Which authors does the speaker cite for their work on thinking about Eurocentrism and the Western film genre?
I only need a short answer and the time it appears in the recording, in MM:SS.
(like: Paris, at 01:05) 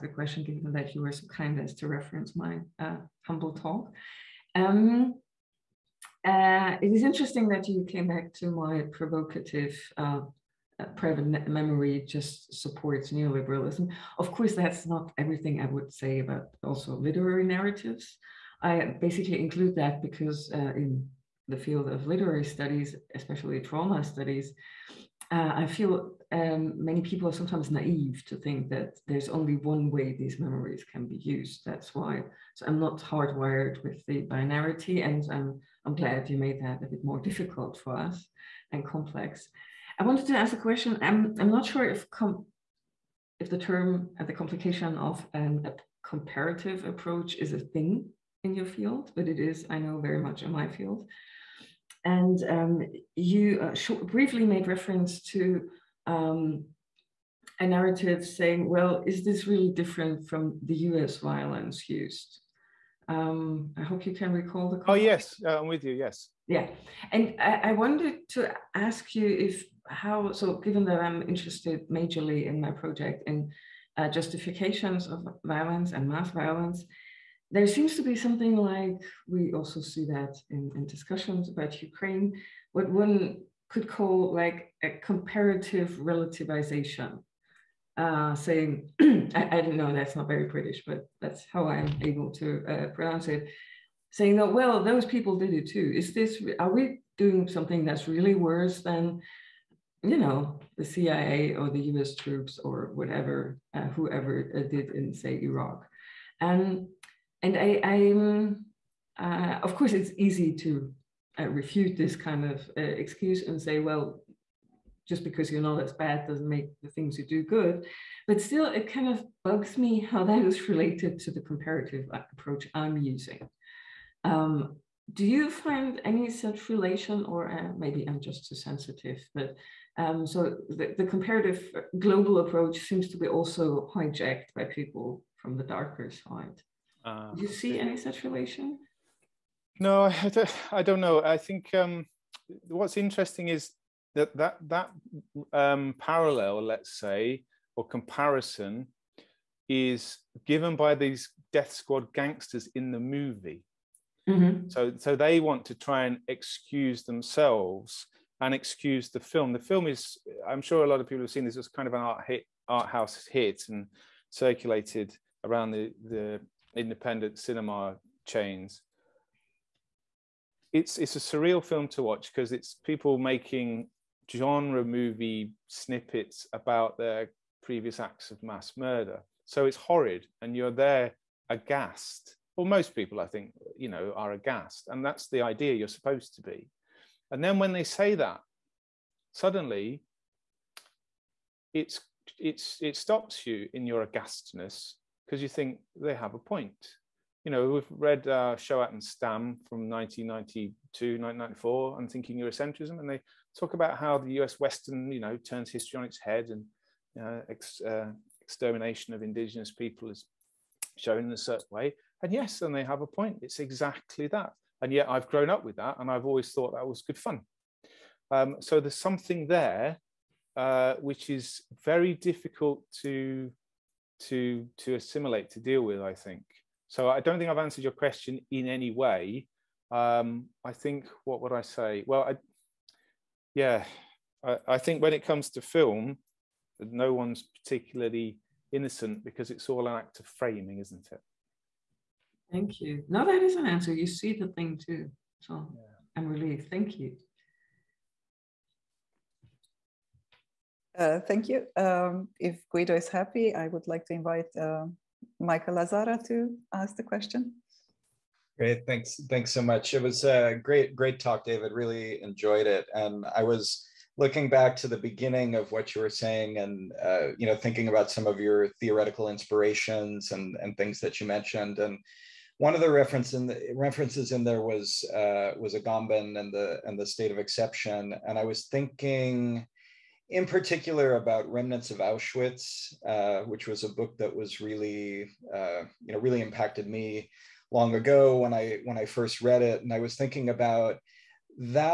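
Shohat and Stam, at 03:18.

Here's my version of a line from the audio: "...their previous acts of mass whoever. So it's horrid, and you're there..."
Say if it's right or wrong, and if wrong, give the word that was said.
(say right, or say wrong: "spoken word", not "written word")
wrong: "murder", not "whoever".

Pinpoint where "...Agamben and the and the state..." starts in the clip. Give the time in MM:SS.
04:35.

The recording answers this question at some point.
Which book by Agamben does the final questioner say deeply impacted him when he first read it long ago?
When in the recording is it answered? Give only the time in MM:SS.
04:41.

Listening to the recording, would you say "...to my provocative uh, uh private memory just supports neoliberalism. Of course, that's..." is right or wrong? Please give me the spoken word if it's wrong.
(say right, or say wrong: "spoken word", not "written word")
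right.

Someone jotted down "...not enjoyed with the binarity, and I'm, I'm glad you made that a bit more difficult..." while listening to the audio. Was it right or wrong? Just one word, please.
wrong.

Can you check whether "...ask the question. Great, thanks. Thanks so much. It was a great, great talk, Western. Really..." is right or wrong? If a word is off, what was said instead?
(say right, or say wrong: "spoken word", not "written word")
wrong: "David", not "Western".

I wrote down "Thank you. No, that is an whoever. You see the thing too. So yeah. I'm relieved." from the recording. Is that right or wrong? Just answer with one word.
wrong.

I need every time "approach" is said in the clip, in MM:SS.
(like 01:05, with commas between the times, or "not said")
00:46, 02:02, 02:12.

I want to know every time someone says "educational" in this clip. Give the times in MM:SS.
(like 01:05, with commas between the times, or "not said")
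not said.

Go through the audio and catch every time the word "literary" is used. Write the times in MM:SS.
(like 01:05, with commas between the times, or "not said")
00:16, 00:22.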